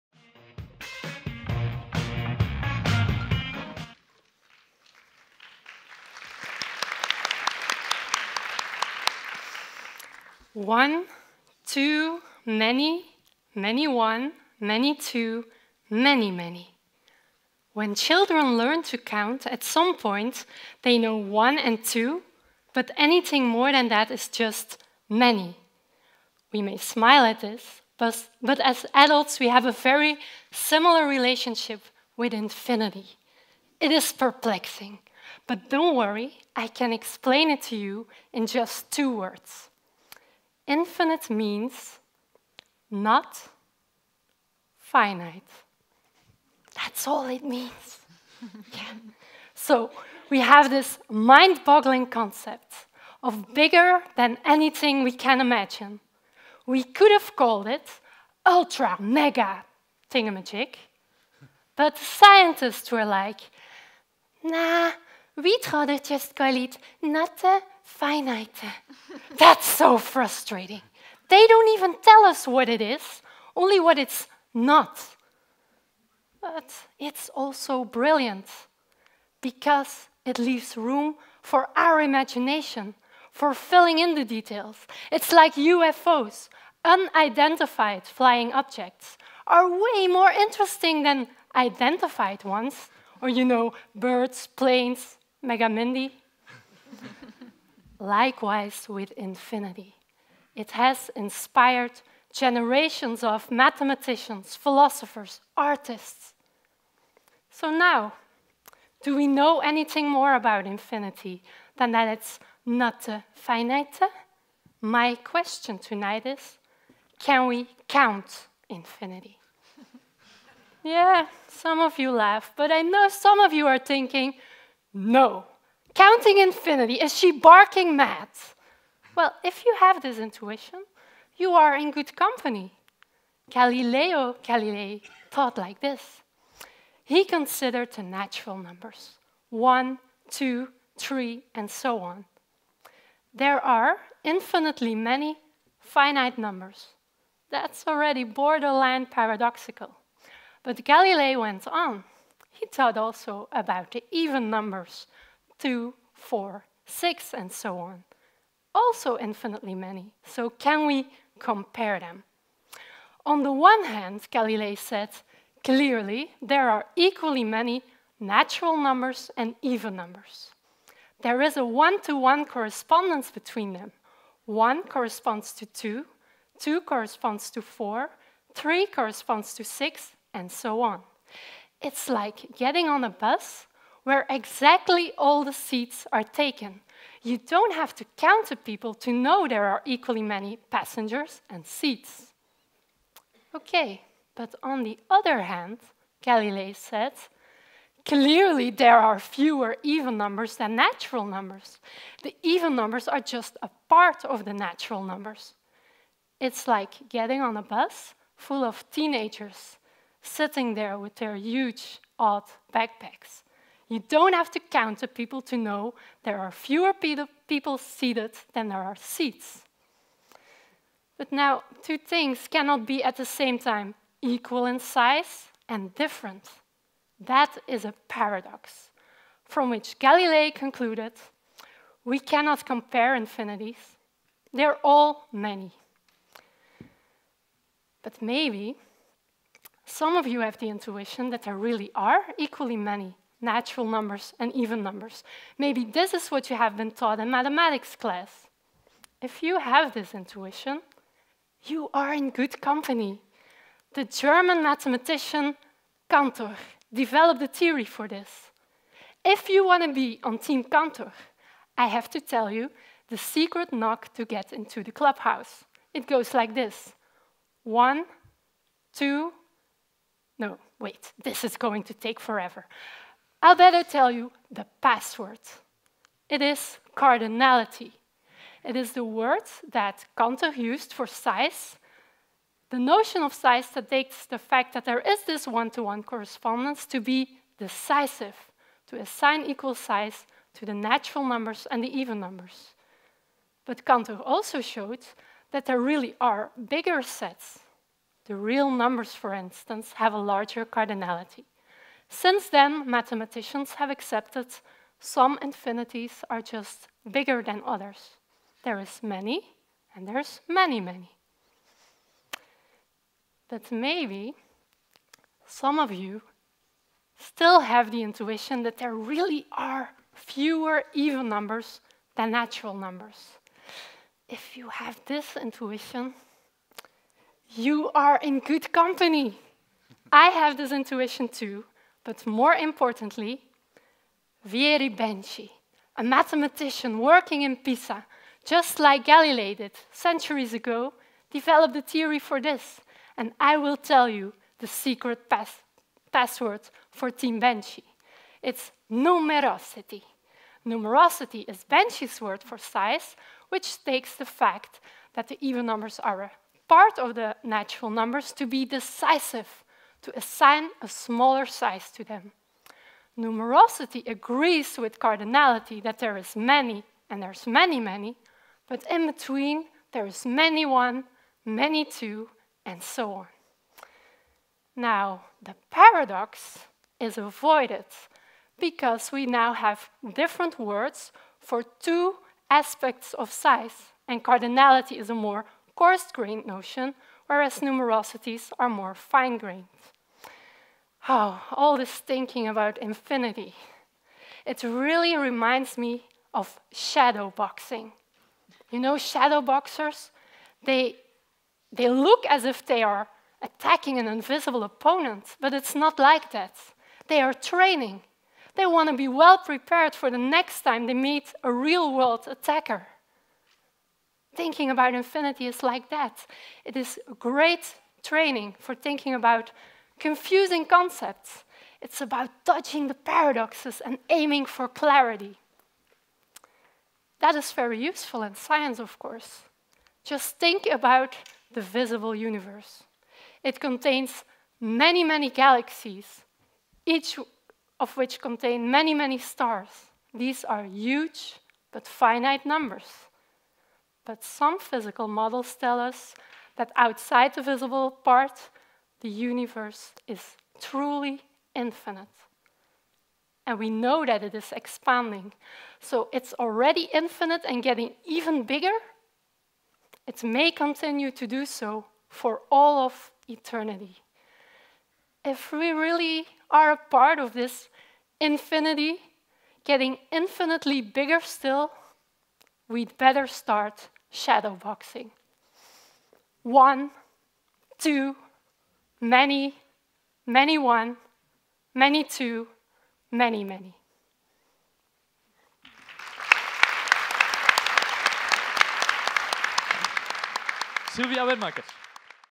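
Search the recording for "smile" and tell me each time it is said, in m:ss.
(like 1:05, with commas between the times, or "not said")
0:26.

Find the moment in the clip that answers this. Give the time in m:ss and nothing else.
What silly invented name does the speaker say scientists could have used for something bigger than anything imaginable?
0:58.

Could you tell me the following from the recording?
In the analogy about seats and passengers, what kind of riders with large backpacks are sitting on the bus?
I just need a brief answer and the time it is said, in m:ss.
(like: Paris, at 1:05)
teenagers, at 3:28.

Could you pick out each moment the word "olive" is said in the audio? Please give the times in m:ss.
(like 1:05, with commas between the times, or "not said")
not said.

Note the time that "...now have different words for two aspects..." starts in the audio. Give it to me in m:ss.
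6:19.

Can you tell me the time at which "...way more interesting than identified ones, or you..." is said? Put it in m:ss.
1:29.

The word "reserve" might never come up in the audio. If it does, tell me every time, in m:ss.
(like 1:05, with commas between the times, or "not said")
not said.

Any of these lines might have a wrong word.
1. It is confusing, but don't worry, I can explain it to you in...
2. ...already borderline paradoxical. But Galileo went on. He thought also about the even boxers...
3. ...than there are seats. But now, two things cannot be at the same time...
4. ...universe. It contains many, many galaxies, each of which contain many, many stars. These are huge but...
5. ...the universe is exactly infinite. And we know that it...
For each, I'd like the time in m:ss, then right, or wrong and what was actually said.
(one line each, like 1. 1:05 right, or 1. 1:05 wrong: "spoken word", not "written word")
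1. 0:33 wrong: "perplexing", not "confusing"
2. 2:27 wrong: "numbers", not "boxers"
3. 3:38 right
4. 7:12 right
5. 7:29 wrong: "truly", not "exactly".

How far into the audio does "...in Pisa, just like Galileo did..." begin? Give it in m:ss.
5:37.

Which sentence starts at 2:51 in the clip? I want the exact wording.
There is a one-to-one -one correspondence between them.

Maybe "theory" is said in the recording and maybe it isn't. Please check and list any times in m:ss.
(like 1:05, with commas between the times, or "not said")
4:17, 5:41.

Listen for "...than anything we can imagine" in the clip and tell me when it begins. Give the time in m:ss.
0:54.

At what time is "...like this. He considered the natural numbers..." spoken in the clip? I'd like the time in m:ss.
2:15.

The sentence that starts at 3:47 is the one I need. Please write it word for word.
That is a paradox, from which Galilei concluded we cannot compare infinities.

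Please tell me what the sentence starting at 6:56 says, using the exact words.
It is great training for thinking about confusing concepts.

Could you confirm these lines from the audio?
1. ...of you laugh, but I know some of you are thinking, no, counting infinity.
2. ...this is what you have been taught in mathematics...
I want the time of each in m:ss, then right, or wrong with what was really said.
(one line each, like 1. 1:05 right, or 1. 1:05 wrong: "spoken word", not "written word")
1. 2:01 right
2. 4:05 right.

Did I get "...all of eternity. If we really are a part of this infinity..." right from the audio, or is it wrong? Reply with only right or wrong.
right.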